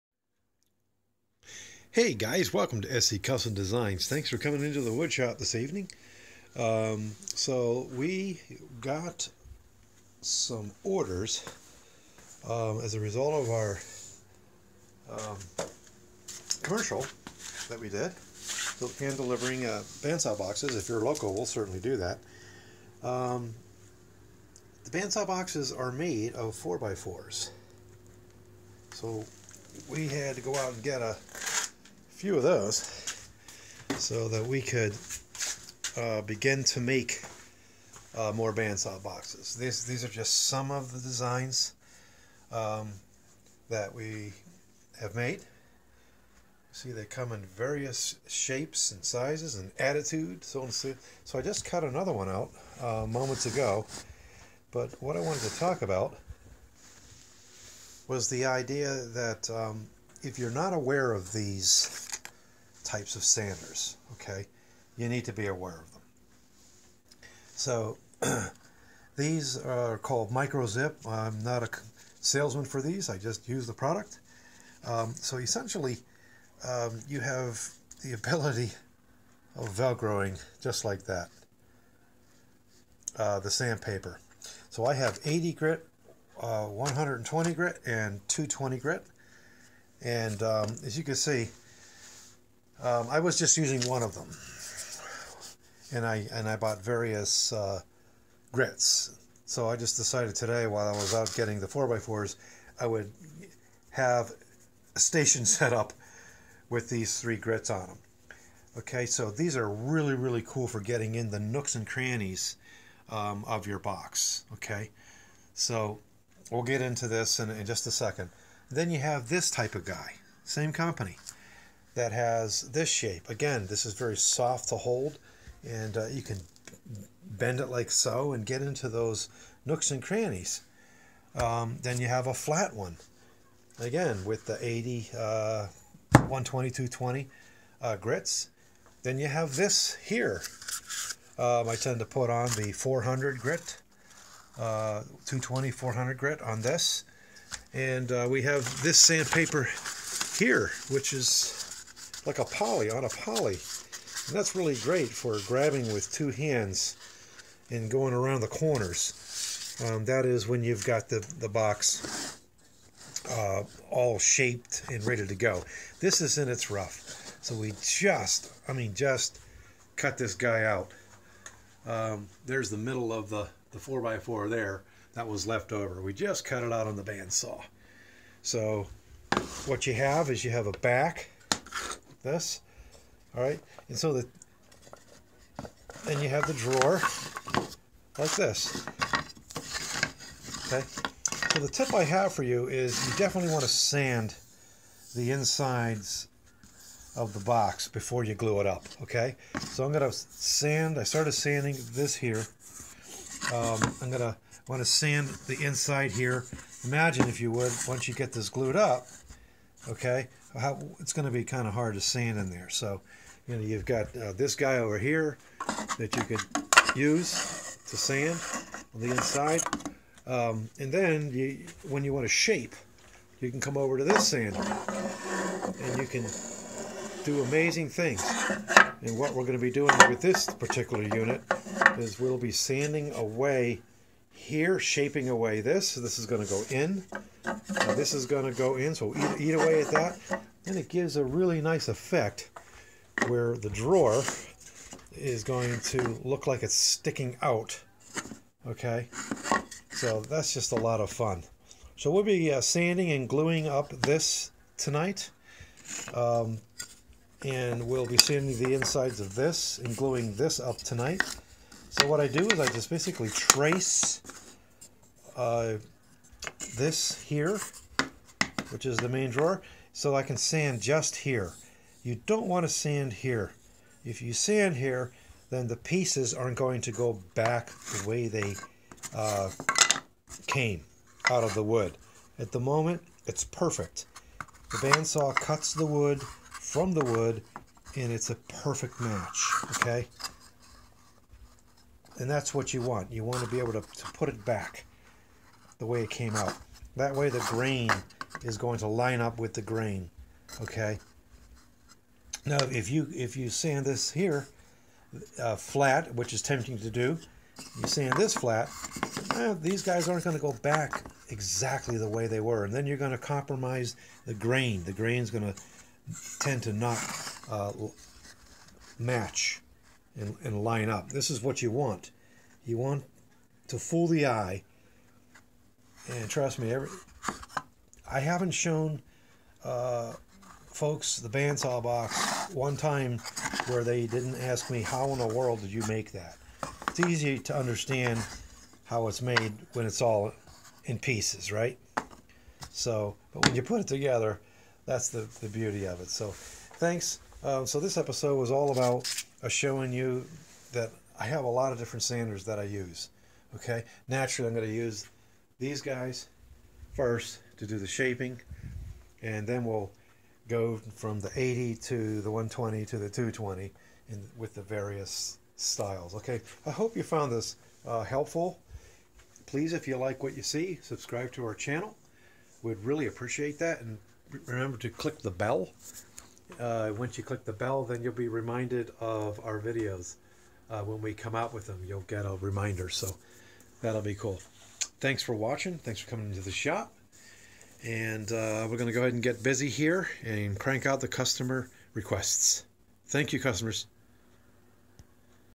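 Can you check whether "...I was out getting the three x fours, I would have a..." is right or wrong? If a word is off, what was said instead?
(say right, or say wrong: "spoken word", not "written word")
wrong: "four", not "three".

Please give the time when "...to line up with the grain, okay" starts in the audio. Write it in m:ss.
4:58.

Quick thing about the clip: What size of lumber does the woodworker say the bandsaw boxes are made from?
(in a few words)
4x4s.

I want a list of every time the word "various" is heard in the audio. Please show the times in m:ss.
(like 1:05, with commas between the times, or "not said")
0:47, 1:36, 6:04.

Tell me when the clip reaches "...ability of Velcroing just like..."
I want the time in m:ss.
1:18.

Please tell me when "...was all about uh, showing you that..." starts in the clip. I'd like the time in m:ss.
5:48.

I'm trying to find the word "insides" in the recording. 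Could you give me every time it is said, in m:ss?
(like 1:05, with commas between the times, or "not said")
3:15, 3:25, 3:39, 4:18.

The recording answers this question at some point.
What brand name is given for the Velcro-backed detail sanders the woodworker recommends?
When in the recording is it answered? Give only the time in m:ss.
1:10.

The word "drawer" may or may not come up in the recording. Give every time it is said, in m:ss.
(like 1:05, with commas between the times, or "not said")
3:06, 4:03, 4:29.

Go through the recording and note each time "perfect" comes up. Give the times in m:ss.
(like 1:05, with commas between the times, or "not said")
4:43, 4:48.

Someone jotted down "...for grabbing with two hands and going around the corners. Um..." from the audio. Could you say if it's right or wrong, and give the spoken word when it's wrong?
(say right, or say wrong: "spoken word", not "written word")
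right.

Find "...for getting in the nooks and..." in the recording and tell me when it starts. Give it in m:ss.
1:50.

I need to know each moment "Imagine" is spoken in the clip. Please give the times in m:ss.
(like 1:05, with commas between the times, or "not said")
3:26.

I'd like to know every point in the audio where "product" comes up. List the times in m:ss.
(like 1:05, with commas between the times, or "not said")
1:13.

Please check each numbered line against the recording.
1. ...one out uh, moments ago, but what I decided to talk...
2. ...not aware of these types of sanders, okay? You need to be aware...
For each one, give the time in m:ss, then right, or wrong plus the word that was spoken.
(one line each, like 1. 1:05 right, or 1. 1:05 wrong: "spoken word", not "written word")
1. 0:52 wrong: "wanted", not "decided"
2. 1:00 right.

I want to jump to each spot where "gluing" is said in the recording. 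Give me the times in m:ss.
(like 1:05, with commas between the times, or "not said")
4:13, 4:19.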